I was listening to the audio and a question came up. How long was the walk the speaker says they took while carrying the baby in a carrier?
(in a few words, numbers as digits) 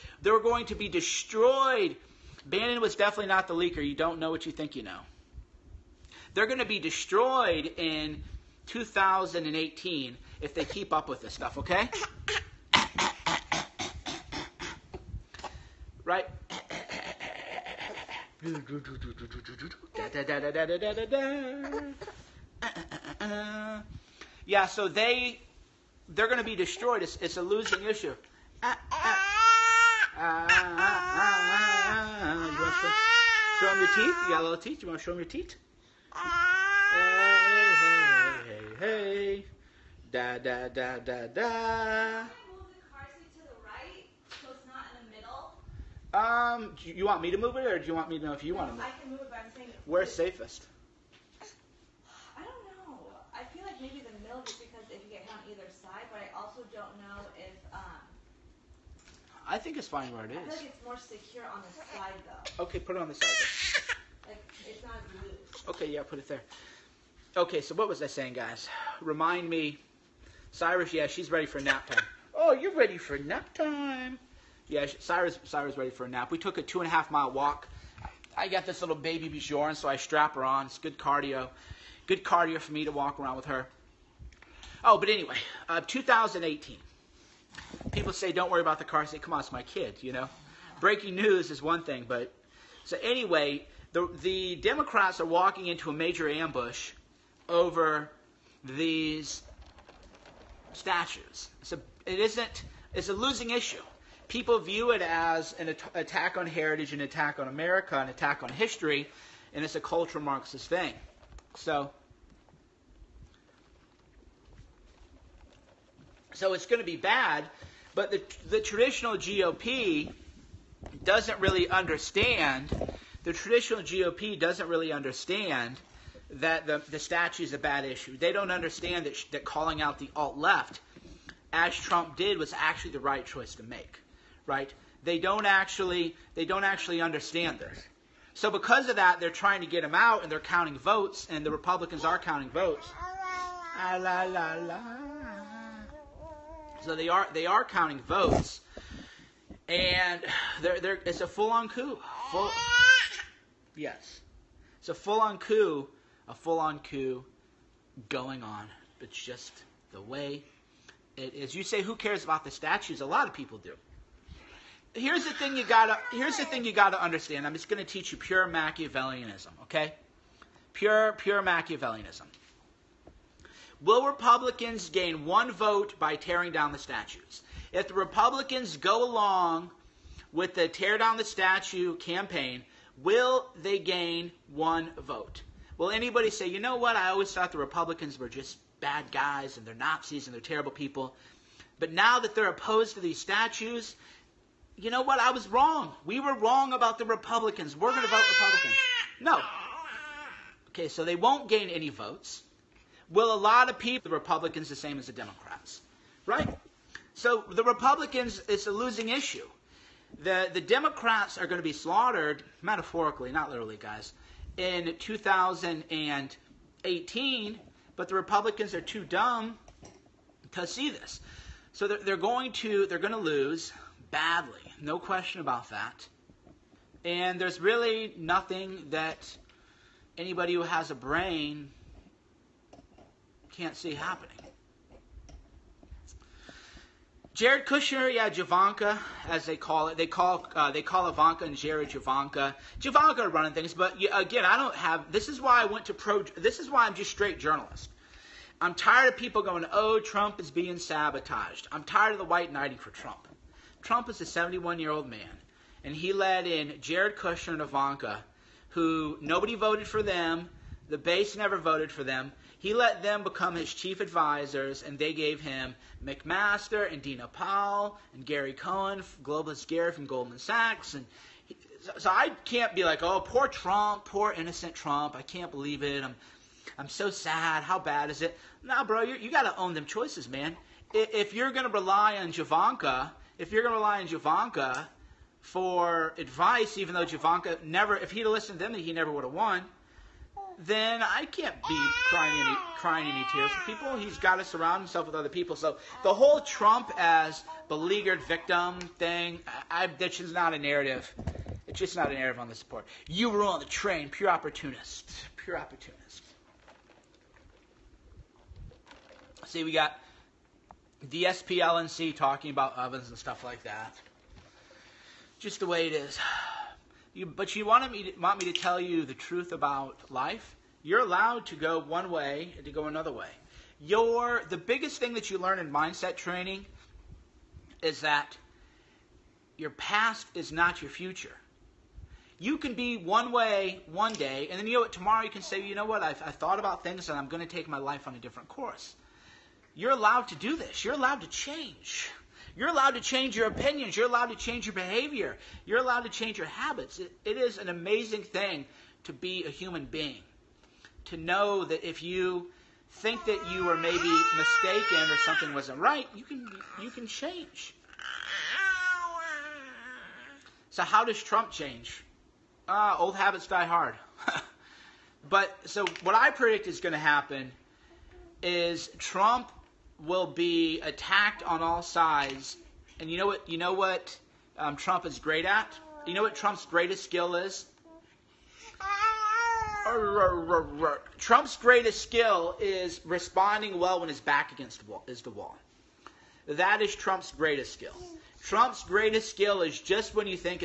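2.5 miles.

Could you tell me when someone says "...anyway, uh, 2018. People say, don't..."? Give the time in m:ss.
1:25.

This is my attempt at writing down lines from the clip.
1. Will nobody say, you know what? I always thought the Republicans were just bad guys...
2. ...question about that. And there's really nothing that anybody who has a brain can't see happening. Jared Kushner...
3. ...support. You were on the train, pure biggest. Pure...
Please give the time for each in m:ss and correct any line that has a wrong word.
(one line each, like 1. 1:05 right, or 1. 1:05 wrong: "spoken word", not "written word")
1. 3:05 wrong: "anybody", not "nobody"
2. 3:44 right
3. 5:02 wrong: "opportunist", not "biggest".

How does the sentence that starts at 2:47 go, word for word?
I'm just gonna teach you pure Machiavellianism, okay?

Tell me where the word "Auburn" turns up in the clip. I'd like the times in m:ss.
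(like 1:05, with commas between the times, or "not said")
not said.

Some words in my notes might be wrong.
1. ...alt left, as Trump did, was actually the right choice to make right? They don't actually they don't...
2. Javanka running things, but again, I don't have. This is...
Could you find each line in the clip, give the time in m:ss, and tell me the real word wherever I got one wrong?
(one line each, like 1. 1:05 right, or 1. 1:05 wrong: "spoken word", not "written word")
1. 2:10 right
2. 4:02 right.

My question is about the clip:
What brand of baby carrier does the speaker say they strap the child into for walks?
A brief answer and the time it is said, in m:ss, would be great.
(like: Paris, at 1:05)
Baby Bjorn, at 1:18.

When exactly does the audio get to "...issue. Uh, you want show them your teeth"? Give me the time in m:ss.
0:27.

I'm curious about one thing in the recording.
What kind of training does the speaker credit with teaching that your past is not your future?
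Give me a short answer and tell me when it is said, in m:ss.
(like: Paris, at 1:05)
mindset training, at 5:25.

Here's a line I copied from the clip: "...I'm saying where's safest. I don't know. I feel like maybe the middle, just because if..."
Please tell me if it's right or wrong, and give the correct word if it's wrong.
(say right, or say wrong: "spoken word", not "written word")
right.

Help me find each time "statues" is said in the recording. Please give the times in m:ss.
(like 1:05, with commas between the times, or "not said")
1:40, 2:06, 2:42, 2:56, 3:01, 3:13.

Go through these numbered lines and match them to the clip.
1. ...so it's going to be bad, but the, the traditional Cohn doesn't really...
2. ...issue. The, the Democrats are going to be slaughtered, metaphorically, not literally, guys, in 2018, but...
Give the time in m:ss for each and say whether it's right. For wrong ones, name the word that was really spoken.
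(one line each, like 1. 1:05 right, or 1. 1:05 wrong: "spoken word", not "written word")
1. 1:56 wrong: "GOP", not "Cohn"
2. 3:29 right.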